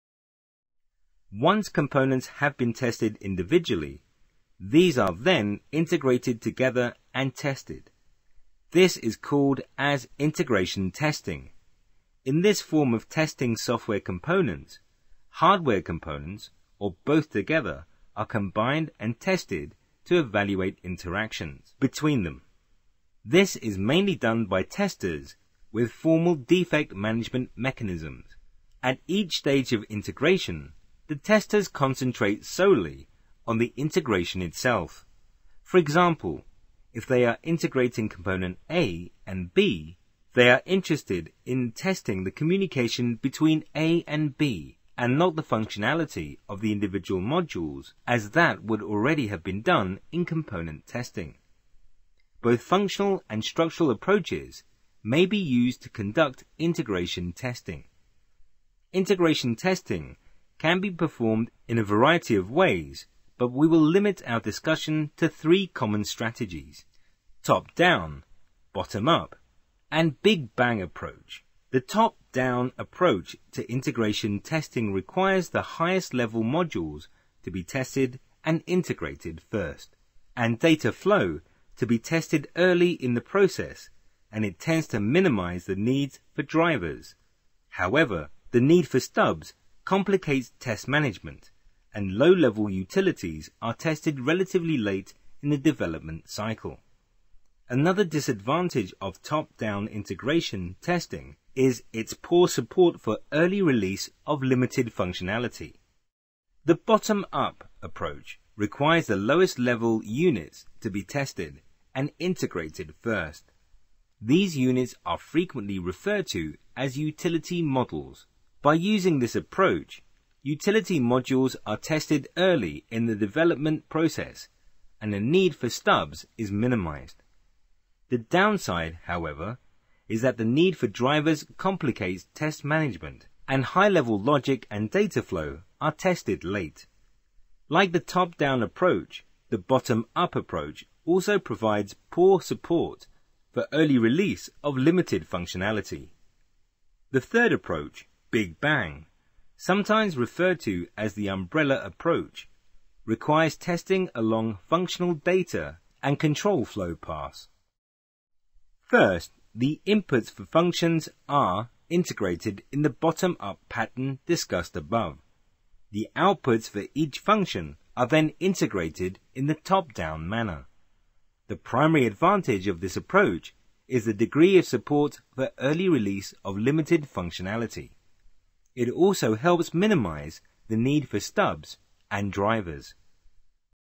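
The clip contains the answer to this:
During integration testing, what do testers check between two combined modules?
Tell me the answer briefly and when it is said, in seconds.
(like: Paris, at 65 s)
Communication, at 42 s.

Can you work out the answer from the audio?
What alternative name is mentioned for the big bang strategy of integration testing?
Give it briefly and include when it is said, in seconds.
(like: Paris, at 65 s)
Umbrella approach, at 151 s.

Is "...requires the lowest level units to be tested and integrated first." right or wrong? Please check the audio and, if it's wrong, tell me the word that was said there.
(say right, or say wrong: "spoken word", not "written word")
right.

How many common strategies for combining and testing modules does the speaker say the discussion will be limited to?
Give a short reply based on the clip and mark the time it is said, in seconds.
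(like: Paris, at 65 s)
3, at 65 s.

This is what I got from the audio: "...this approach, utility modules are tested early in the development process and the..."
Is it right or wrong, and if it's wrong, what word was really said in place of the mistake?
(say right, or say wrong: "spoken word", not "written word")
right.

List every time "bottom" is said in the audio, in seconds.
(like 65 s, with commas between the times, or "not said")
68 s, 106 s, 139 s, 162 s.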